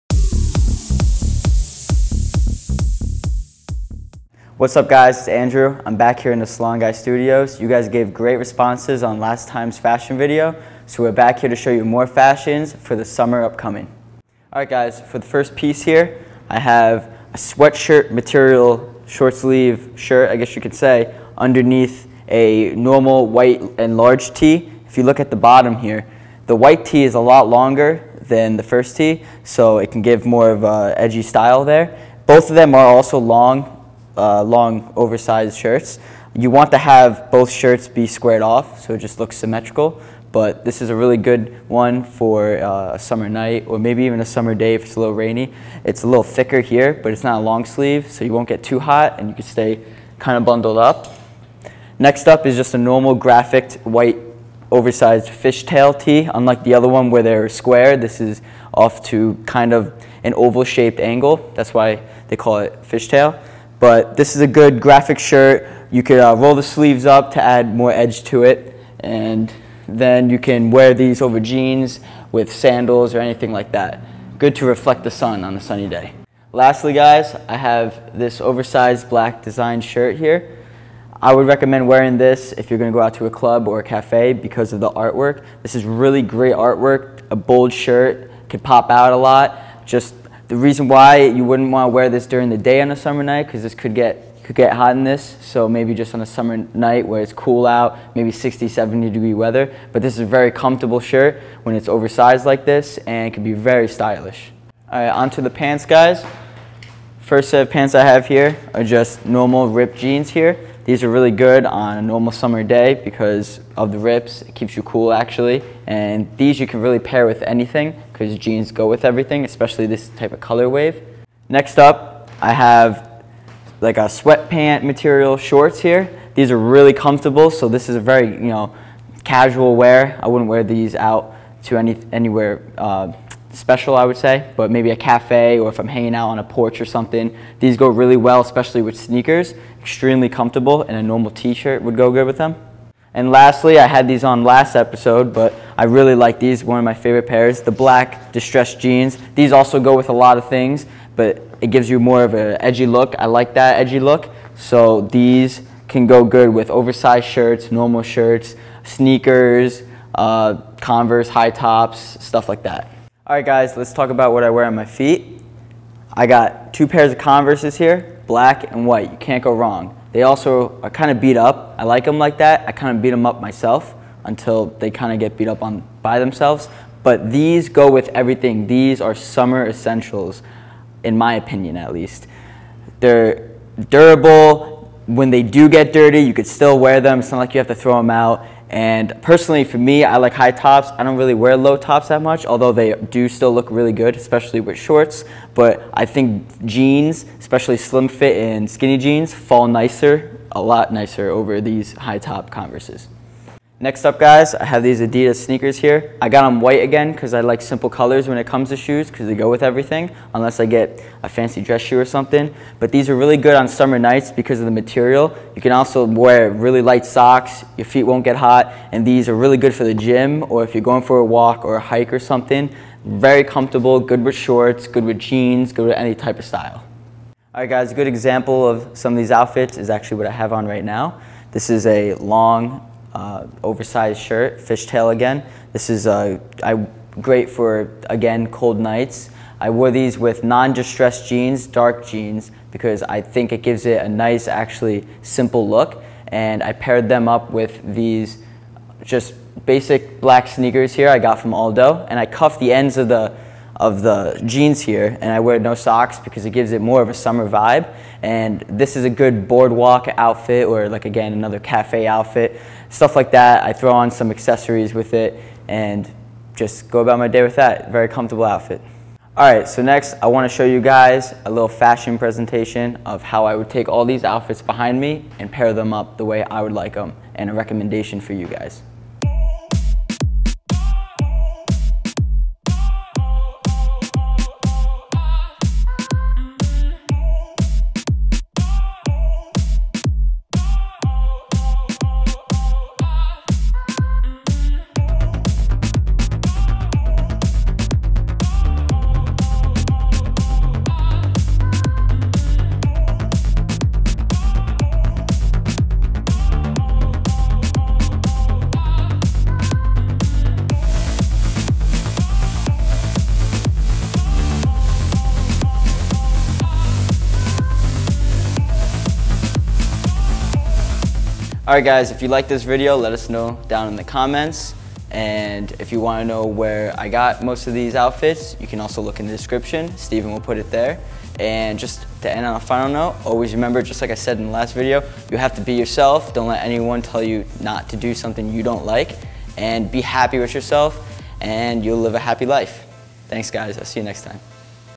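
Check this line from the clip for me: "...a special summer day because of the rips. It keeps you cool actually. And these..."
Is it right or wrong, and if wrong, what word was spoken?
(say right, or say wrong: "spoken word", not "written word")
wrong: "normal", not "special".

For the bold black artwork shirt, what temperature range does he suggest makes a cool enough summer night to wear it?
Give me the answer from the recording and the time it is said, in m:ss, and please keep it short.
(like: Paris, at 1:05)
60 70 degrees, at 1:38.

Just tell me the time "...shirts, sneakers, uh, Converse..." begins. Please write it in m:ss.
2:38.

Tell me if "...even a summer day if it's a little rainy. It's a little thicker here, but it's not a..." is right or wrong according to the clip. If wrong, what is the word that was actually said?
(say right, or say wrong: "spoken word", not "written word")
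right.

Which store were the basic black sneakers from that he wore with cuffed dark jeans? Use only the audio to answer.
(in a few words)
Aldo.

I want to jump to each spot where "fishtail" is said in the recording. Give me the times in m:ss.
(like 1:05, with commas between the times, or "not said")
0:55, 1:02, 3:54.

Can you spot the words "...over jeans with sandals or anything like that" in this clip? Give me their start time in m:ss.
1:11.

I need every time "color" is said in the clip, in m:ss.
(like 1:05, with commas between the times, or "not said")
2:00, 3:27.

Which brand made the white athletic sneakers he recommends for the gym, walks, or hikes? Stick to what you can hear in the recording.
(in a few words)
Adidas.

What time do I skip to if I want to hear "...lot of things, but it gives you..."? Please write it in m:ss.
2:30.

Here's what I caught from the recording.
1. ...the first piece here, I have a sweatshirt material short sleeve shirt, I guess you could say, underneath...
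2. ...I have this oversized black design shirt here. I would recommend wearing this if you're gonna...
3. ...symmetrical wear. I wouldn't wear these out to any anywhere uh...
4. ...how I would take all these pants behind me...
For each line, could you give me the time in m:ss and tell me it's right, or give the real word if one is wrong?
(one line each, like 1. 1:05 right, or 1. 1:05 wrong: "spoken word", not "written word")
1. 0:15 right
2. 1:17 right
3. 2:09 wrong: "casual", not "symmetrical"
4. 4:33 wrong: "outfits", not "pants".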